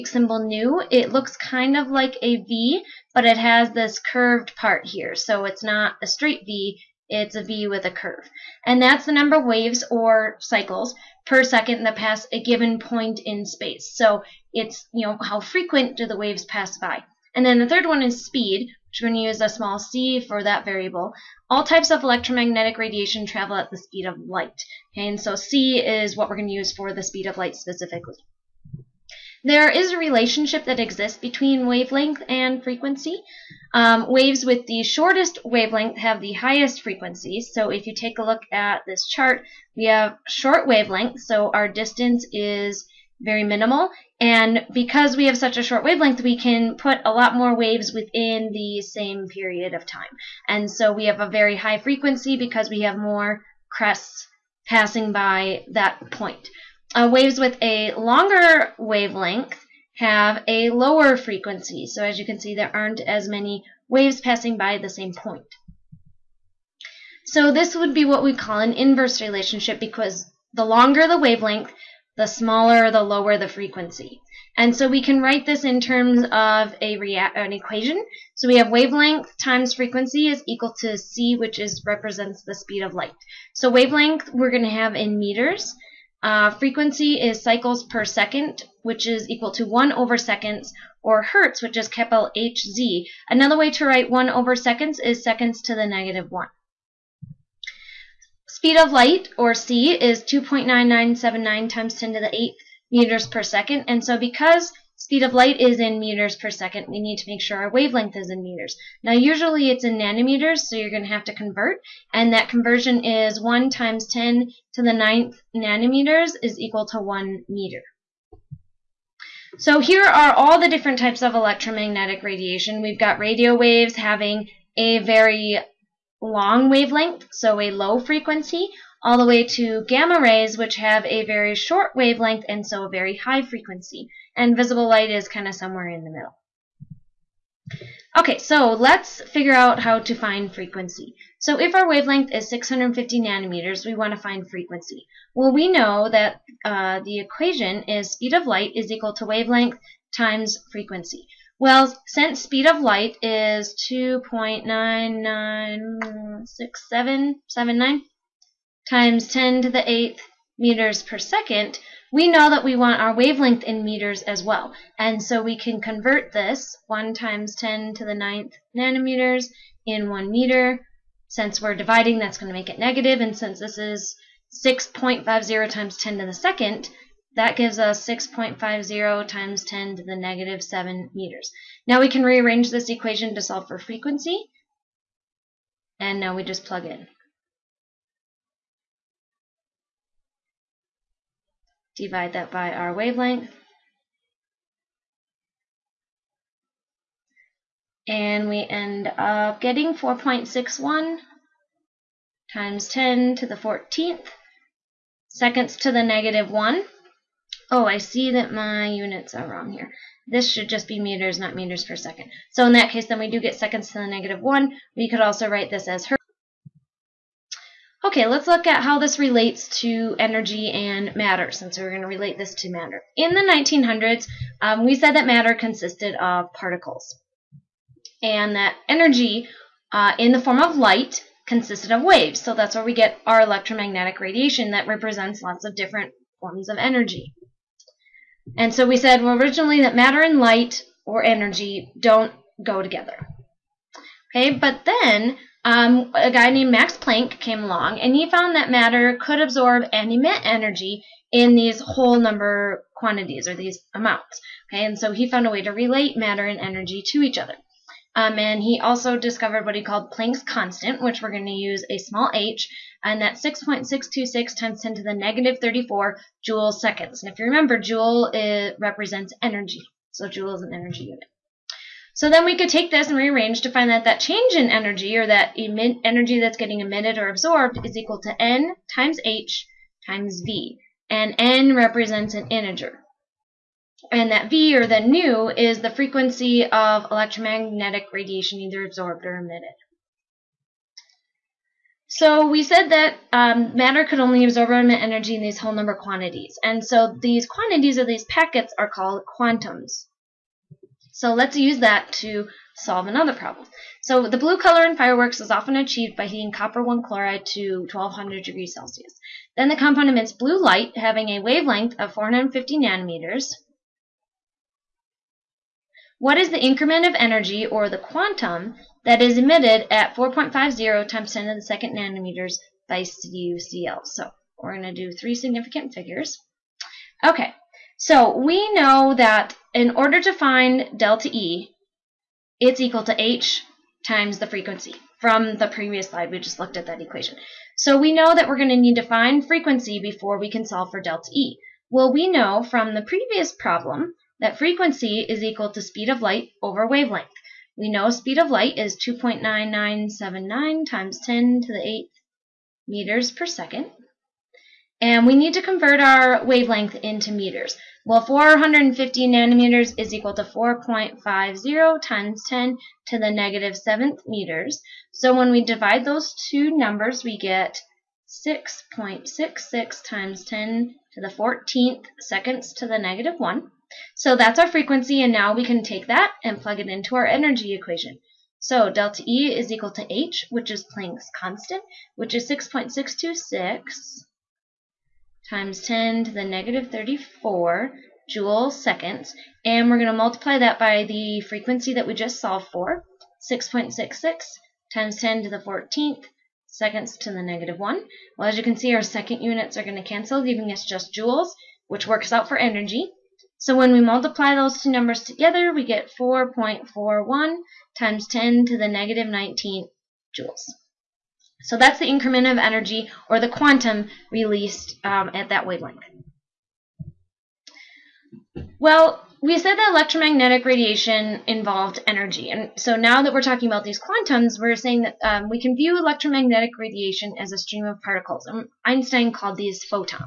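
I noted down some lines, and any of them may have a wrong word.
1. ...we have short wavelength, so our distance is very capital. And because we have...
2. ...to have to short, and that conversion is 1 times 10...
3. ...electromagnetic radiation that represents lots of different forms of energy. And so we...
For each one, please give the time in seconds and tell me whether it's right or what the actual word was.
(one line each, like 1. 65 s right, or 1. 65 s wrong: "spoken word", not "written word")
1. 39 s wrong: "minimal", not "capital"
2. 111 s wrong: "convert", not "short"
3. 233 s right.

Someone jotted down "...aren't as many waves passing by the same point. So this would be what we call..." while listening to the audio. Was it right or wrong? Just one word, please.
right.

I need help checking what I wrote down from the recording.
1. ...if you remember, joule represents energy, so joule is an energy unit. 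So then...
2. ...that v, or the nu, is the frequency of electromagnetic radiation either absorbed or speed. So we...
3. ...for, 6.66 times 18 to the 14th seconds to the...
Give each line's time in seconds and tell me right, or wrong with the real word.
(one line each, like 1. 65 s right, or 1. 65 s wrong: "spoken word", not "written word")
1. 267 s right
2. 284 s wrong: "emitted", not "speed"
3. 392 s wrong: "10", not "18".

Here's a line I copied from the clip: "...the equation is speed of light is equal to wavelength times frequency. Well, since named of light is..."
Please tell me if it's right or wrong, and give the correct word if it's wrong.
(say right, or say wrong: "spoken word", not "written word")
wrong: "speed", not "named".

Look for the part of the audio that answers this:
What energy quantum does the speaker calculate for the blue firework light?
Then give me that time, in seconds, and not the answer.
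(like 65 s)
406 s.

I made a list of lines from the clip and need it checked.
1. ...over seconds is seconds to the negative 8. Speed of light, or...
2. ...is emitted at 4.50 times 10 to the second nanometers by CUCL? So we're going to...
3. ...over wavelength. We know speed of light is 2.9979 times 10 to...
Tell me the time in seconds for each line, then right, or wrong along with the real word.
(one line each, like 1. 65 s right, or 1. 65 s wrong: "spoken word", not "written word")
1. 94 s wrong: "1", not "8"
2. 319 s right
3. 346 s right.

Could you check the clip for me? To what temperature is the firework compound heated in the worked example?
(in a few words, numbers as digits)
1200 degrees Celsius.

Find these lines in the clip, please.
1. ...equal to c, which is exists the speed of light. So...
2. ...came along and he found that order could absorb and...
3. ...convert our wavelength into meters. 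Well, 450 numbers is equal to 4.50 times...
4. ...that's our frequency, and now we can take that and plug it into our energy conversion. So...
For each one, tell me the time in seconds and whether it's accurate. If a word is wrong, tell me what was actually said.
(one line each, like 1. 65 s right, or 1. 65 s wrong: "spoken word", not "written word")
1. 80 s wrong: "represents", not "exists"
2. 247 s wrong: "matter", not "order"
3. 355 s wrong: "nanometers", not "numbers"
4. 374 s wrong: "equation", not "conversion".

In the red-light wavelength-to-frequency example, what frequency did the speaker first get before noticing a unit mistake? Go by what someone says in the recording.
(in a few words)
4.61 x 10^14 s^-1.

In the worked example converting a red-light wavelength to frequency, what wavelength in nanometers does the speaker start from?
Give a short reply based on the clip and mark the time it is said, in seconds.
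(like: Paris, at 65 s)
650 nanometers, at 142 s.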